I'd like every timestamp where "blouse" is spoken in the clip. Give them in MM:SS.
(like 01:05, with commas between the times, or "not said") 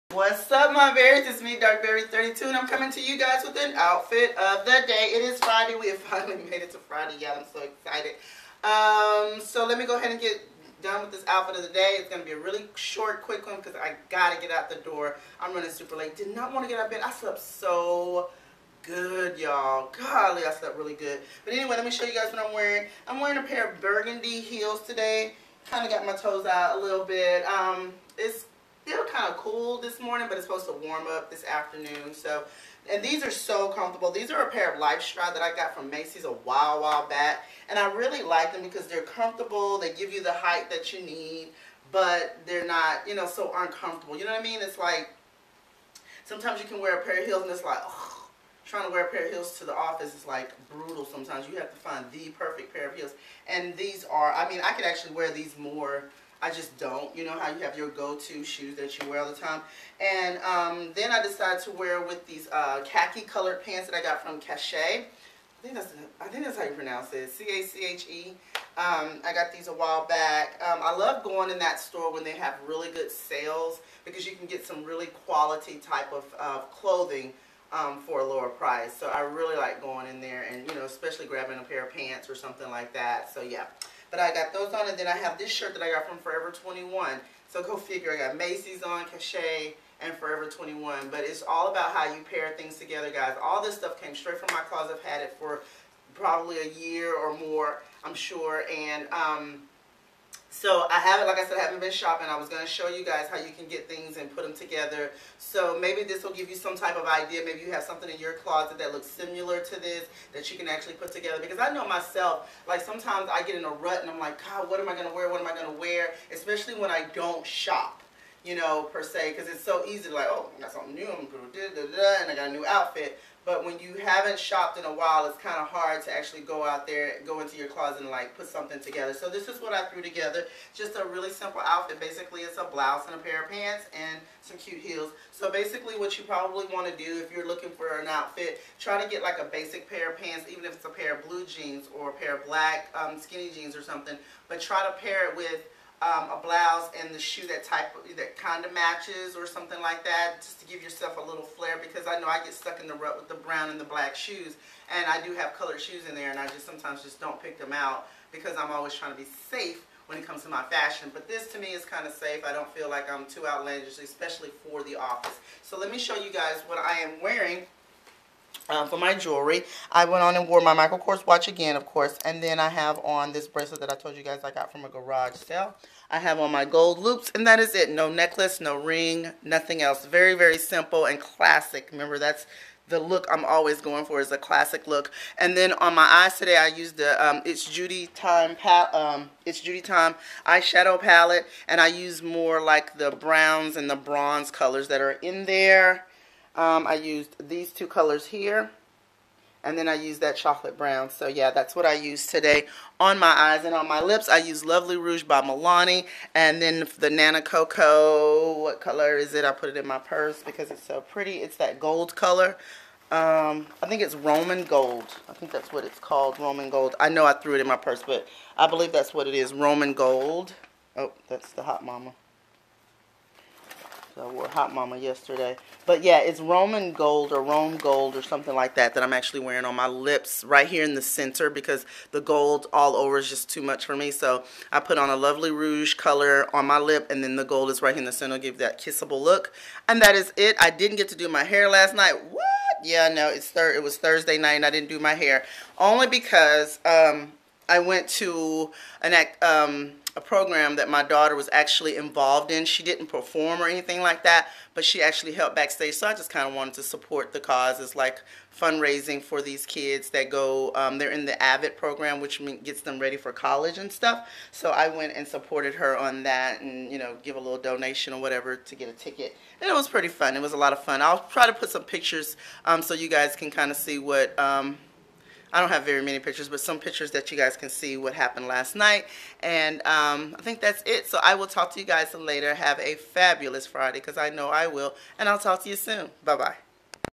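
02:12, 02:26.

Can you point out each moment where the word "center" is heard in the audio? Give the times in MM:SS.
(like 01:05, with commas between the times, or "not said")
03:51, 03:58.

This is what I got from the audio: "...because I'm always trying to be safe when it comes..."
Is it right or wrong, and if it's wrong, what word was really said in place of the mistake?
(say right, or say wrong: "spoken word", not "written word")
right.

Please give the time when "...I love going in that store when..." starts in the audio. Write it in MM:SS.
01:10.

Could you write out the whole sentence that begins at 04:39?
And um, I think that's it.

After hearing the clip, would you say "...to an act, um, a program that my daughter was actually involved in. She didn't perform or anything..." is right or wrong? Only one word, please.
right.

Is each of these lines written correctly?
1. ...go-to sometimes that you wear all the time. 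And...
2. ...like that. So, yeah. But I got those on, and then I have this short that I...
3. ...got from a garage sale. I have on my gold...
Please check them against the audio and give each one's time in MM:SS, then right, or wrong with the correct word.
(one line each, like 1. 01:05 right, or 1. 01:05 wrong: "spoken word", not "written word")
1. 00:57 wrong: "shoes", not "sometimes"
2. 01:22 wrong: "shirt", not "short"
3. 02:54 right.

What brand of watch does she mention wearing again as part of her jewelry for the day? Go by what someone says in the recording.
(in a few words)
Michael Kors.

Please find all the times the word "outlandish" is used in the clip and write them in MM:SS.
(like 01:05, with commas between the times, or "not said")
02:43.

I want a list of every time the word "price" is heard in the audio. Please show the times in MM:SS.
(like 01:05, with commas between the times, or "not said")
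01:18.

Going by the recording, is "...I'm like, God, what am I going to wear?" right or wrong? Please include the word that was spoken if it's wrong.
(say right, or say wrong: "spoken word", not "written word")
right.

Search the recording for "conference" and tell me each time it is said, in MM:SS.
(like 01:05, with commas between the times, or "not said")
not said.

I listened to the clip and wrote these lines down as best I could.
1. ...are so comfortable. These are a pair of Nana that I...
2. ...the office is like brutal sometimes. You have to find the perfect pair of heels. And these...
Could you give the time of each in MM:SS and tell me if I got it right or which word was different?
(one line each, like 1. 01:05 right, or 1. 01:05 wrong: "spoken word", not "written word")
1. 00:33 wrong: "Stride", not "Nana"
2. 00:49 right.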